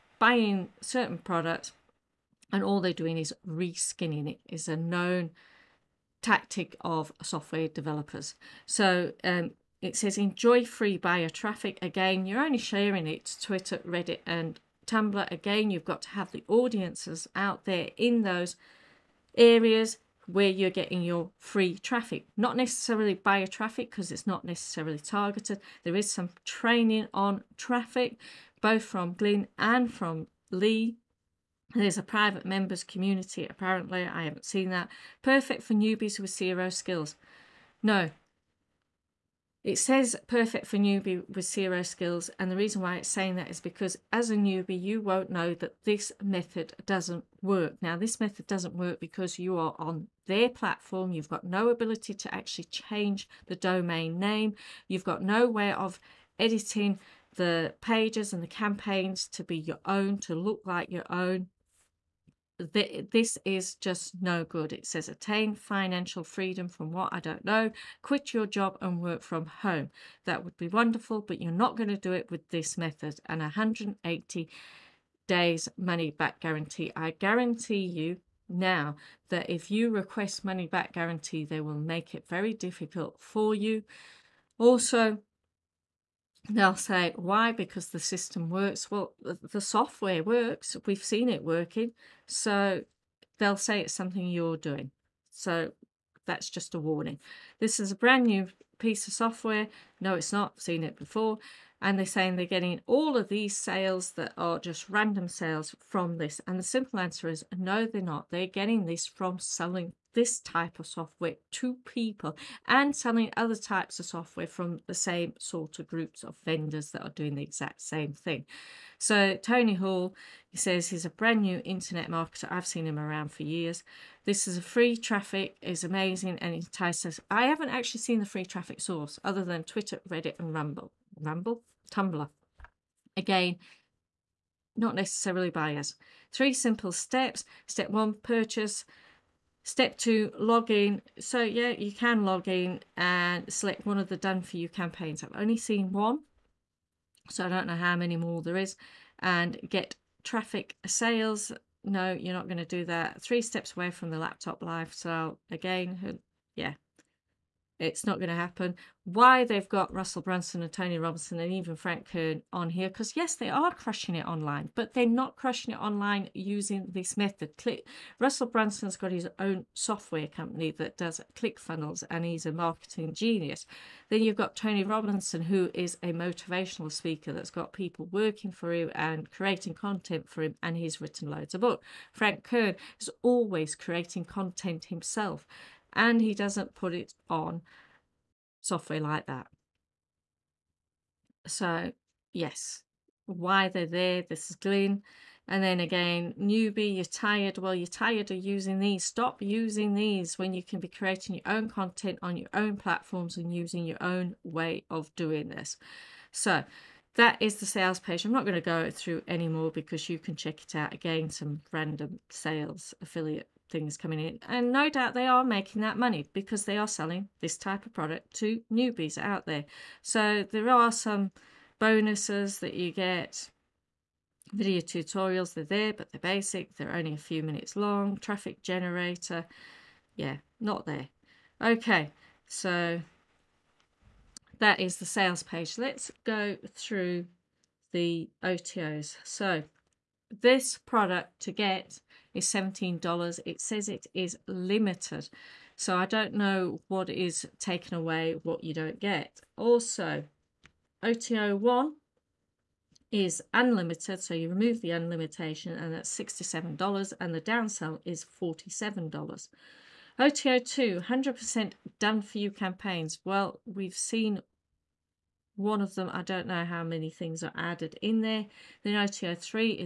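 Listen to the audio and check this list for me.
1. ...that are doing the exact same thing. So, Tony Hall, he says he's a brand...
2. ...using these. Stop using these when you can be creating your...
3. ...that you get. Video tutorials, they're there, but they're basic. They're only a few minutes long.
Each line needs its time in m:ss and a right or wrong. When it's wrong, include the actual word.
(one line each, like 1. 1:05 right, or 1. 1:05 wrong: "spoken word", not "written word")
1. 1:56 right
2. 3:18 right
3. 3:42 right.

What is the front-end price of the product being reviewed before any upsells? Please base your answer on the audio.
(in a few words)
$17.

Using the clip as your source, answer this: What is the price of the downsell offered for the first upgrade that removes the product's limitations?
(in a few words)
$47.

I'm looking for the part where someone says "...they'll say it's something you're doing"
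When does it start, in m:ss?
1:33.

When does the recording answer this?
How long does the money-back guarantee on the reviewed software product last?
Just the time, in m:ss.
1:13.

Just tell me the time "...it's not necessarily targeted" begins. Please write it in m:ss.
0:24.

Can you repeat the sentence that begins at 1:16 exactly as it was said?
I guarantee you now that if you request money back guarantee, they will make it very difficult for you.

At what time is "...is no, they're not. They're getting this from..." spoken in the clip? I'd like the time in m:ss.
1:47.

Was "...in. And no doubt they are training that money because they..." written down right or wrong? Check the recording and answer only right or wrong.
wrong.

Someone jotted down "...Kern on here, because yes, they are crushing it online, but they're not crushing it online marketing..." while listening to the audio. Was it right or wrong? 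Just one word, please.
wrong.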